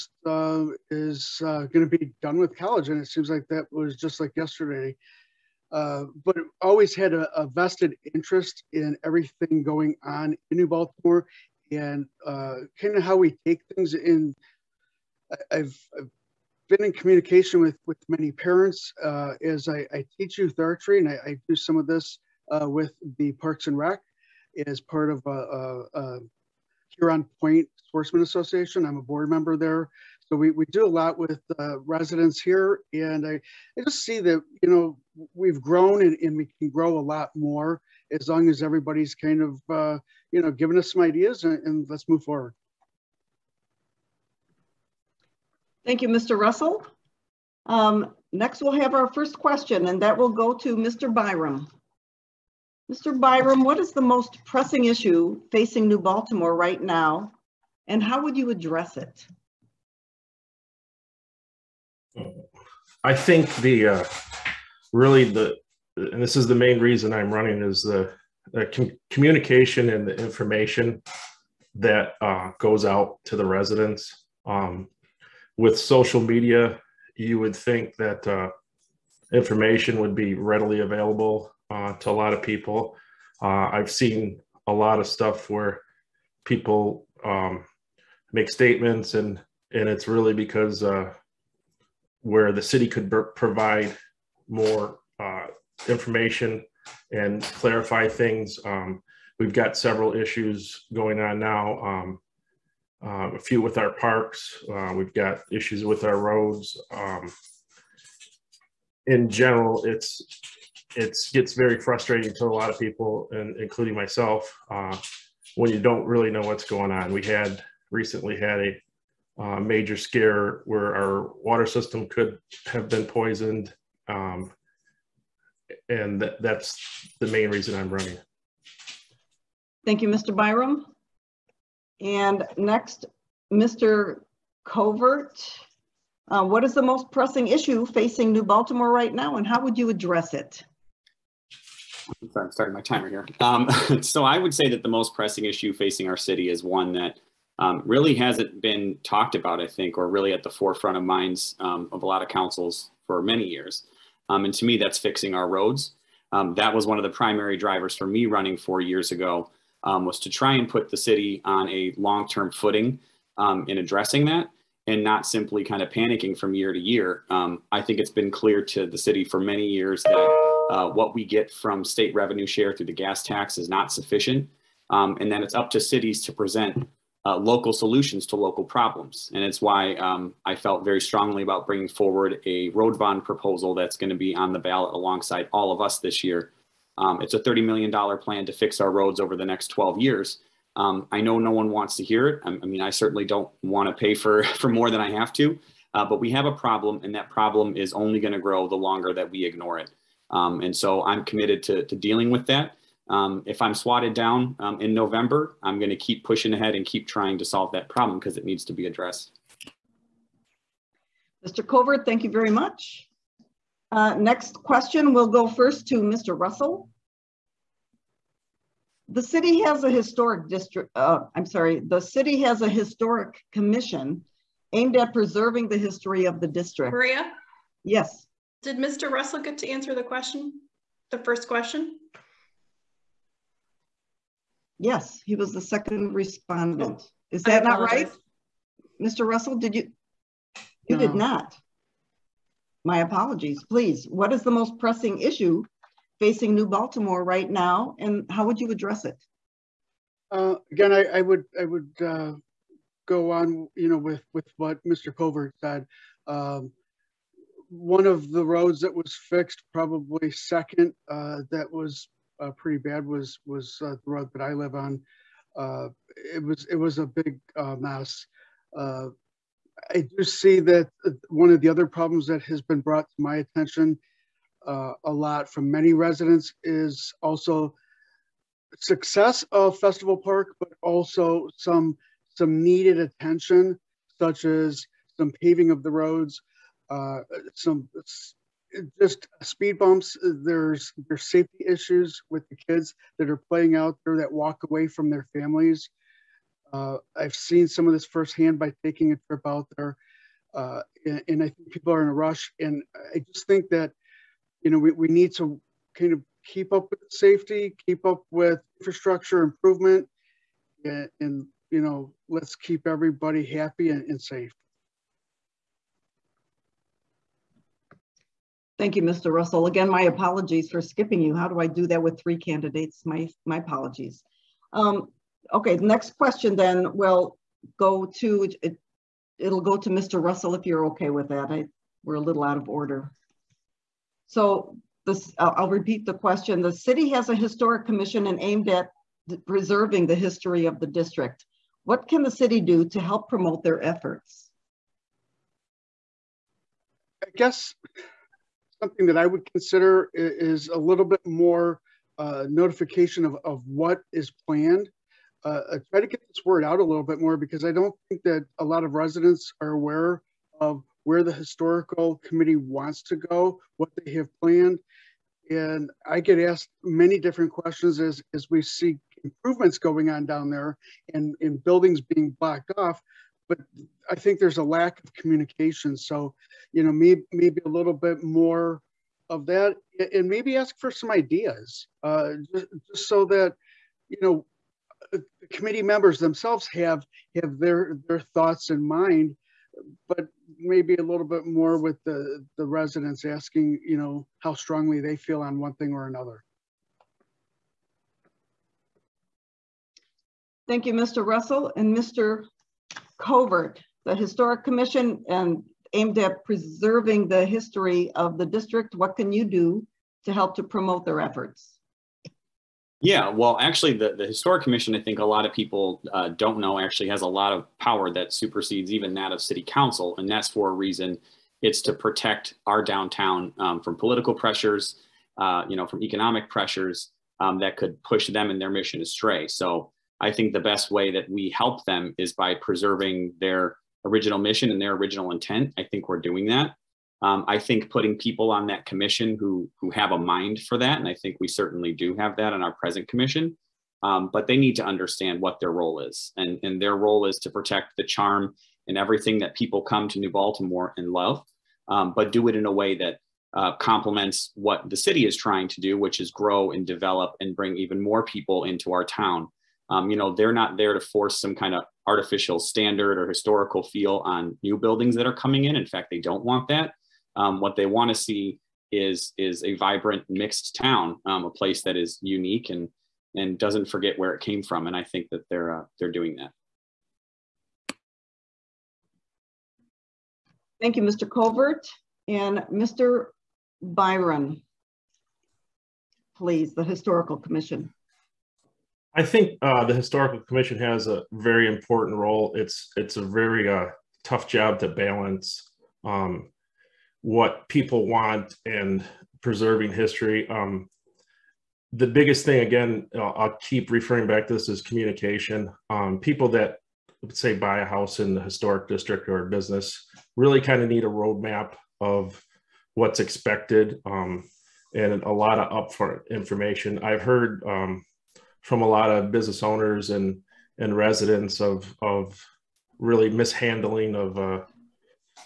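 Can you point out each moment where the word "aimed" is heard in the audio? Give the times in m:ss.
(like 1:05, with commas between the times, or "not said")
3:44, 5:38, 6:45.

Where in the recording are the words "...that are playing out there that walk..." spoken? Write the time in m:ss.
4:53.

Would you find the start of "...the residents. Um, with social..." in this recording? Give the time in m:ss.
1:13.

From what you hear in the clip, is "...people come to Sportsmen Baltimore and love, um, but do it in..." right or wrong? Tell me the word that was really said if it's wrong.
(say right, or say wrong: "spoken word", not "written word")
wrong: "New", not "Sportsmen".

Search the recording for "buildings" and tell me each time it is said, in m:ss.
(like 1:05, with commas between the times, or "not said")
6:11, 7:44.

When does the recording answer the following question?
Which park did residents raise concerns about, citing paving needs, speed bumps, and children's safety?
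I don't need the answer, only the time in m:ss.
4:39.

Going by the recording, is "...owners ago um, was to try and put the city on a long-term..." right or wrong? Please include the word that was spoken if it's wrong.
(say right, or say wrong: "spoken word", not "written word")
wrong: "years", not "owners".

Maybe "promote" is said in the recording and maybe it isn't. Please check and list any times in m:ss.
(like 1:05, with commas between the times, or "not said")
5:43, 6:50.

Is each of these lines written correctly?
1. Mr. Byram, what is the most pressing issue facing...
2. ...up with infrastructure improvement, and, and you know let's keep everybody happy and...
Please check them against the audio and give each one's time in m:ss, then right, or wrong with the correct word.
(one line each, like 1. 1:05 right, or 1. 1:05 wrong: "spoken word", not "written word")
1. 0:52 right
2. 5:08 right.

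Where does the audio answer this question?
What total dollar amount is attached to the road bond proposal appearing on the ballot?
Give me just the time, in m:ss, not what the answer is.
3:07.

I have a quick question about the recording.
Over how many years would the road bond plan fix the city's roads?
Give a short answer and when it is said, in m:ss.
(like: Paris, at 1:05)
12, at 3:09.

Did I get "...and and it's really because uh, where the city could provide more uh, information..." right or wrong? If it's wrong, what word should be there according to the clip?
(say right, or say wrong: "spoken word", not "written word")
right.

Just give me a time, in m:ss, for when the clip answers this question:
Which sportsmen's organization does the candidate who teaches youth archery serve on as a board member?
0:26.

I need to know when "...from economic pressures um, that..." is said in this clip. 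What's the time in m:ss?
7:05.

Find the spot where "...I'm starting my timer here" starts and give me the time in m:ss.
2:22.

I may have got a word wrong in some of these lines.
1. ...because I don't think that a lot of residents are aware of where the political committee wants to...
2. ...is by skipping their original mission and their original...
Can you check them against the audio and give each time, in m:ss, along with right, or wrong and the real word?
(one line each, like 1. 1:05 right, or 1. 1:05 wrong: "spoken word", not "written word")
1. 5:57 wrong: "historical", not "political"
2. 7:12 wrong: "preserving", not "skipping".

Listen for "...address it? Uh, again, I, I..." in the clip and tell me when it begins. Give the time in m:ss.
4:08.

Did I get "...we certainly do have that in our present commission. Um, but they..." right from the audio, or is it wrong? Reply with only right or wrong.
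right.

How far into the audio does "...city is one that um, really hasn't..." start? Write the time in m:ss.
2:26.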